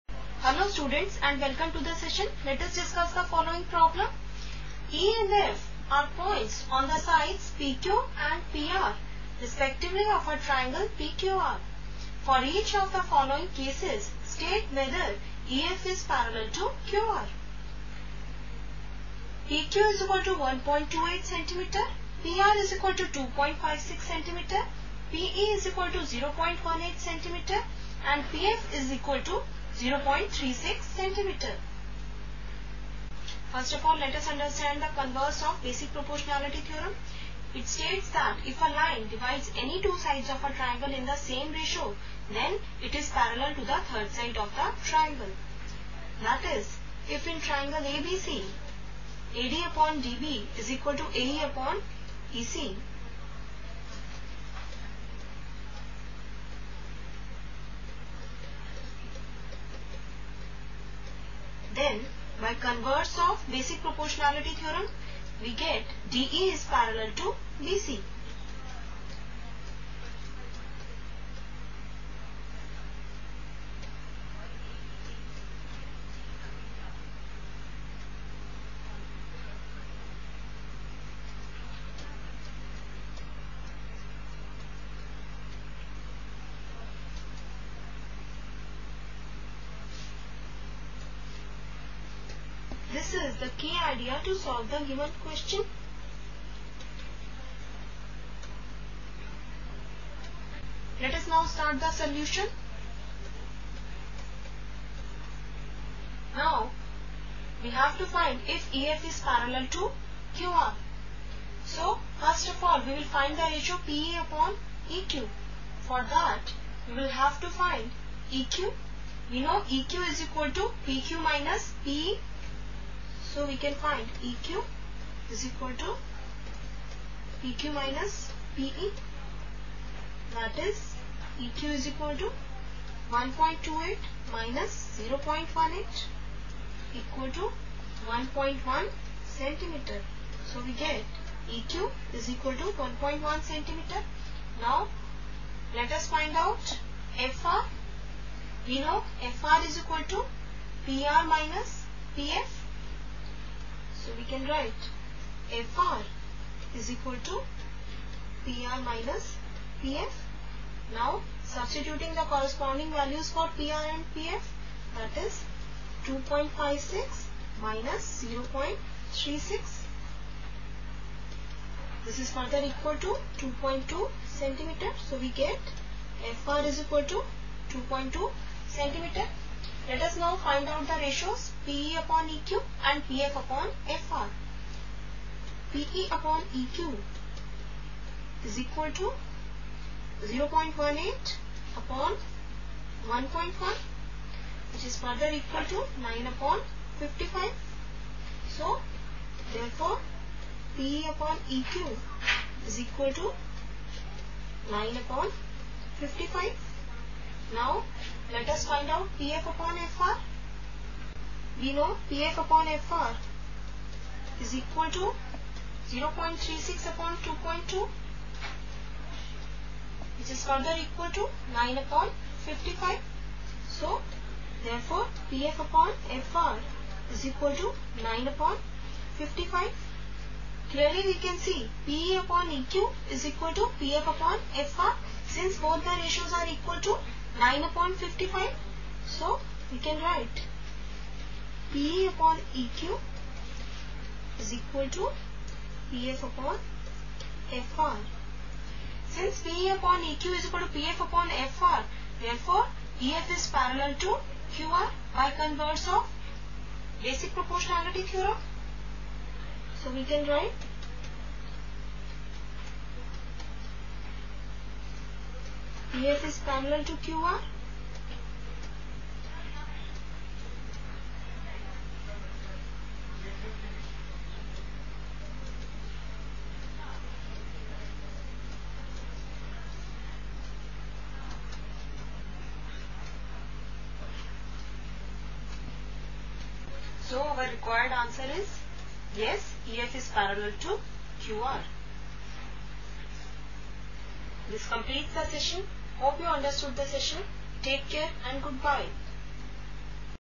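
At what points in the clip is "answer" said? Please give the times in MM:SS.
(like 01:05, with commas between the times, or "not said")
04:47.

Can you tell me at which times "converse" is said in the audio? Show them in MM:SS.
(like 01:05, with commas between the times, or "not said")
00:34, 01:02, 04:15.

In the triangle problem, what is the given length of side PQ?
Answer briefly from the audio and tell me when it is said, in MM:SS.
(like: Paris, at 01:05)
1.28 cm, at 00:19.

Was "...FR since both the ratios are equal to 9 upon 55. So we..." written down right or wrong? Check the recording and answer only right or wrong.
right.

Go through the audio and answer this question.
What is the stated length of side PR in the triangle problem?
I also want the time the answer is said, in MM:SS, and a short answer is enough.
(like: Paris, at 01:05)
2.56 cm, at 00:22.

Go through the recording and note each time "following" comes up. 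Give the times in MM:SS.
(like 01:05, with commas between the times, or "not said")
00:03, 00:13.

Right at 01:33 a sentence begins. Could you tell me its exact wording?
This is the key idea to solve the given question.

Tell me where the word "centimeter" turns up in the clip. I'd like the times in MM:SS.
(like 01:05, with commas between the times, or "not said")
00:30, 02:19, 02:23, 02:54, 02:58.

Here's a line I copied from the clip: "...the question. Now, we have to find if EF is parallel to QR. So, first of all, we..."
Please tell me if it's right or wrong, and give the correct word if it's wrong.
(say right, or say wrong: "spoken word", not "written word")
wrong: "solution", not "question".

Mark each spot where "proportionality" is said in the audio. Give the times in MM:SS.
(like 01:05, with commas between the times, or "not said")
00:35, 01:03, 04:17.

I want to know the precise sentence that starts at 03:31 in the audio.
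We know PF upon FR is equal to 0.36 upon 2.2 which is further equal to 9 upon 55.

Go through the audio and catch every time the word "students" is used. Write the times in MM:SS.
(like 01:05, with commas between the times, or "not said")
00:00.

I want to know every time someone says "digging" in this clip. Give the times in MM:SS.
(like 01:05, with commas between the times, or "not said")
not said.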